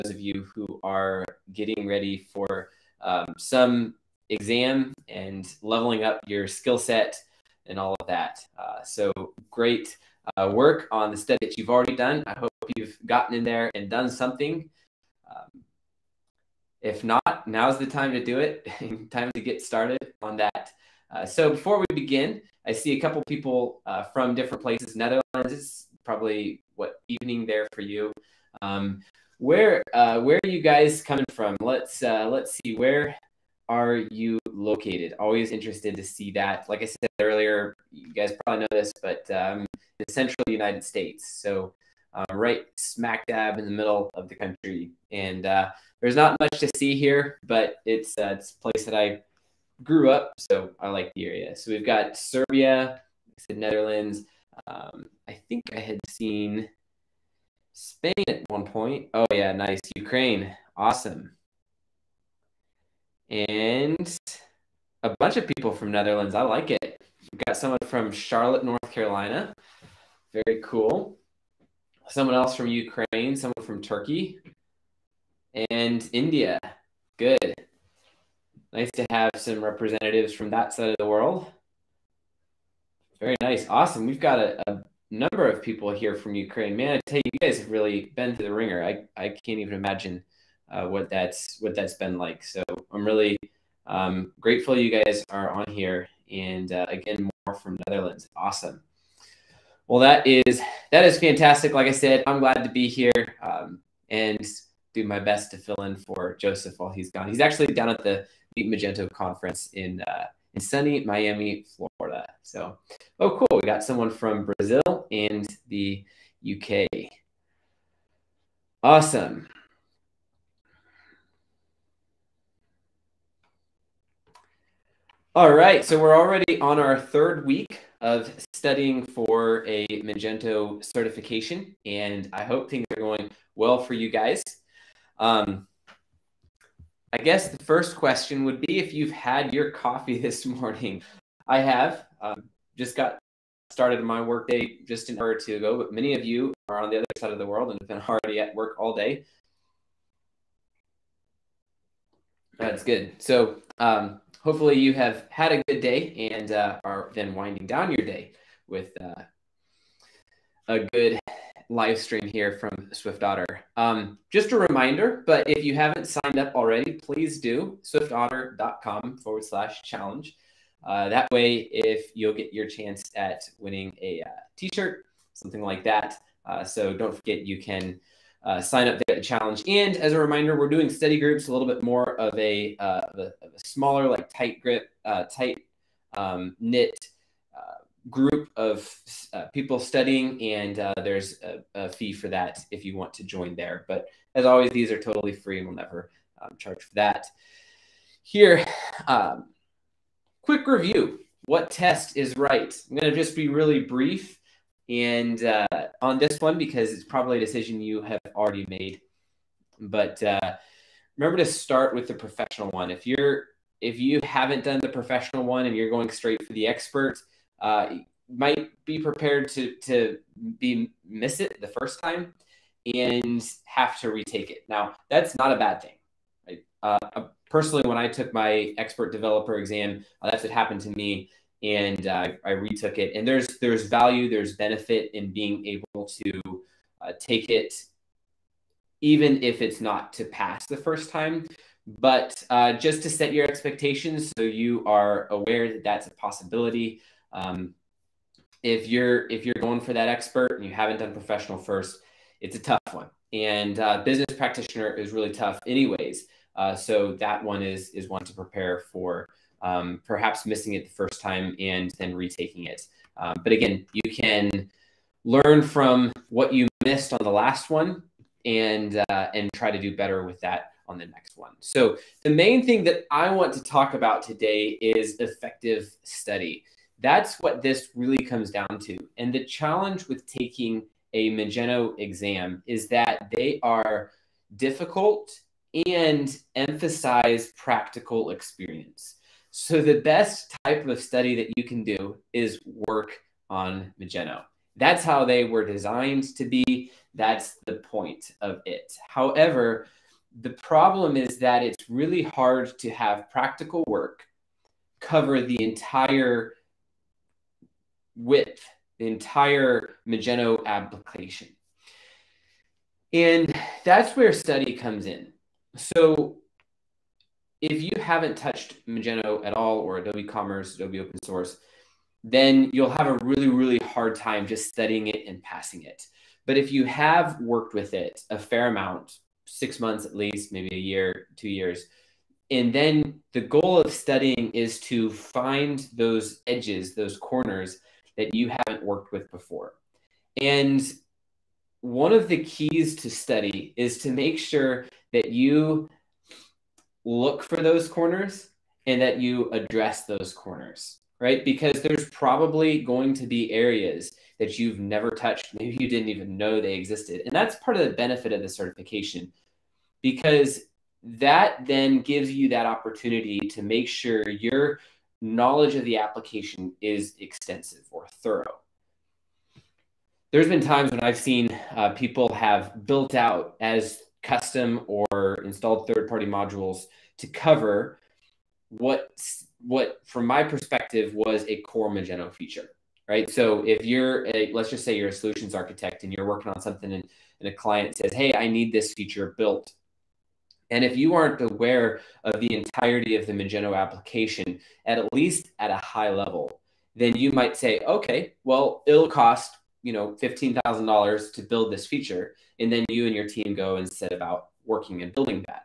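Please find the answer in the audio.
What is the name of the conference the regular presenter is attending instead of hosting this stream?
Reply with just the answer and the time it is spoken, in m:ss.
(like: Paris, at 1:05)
Meet Magento, at 1:48.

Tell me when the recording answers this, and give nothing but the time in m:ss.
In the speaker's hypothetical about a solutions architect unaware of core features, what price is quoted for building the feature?
6:40.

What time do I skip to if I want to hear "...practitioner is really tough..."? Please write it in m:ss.
4:14.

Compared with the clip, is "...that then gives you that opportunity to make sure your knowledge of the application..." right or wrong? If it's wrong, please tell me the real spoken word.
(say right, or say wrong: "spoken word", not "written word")
right.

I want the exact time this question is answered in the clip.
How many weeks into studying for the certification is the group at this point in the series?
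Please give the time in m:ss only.
2:06.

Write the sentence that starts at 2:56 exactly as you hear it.
Uh, so don't forget you can uh, sign up the challenge.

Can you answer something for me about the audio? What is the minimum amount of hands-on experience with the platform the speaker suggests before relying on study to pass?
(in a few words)
6 months.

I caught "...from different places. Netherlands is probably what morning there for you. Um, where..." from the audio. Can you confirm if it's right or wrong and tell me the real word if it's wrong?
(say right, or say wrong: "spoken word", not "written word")
wrong: "evening", not "morning".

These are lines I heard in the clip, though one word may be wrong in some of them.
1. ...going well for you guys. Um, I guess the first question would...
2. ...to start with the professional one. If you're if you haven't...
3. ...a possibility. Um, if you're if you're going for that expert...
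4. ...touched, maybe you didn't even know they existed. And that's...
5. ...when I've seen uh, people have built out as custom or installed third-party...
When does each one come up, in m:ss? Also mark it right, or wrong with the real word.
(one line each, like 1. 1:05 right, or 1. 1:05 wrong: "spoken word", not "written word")
1. 2:12 right
2. 3:31 right
3. 4:06 right
4. 5:55 right
5. 6:10 right.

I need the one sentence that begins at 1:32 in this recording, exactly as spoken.
So I'm really um, grateful you guys are on here, and uh, again, more from Netherlands.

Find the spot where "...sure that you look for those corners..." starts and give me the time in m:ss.
5:44.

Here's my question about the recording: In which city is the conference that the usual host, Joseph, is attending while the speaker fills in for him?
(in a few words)
Miami.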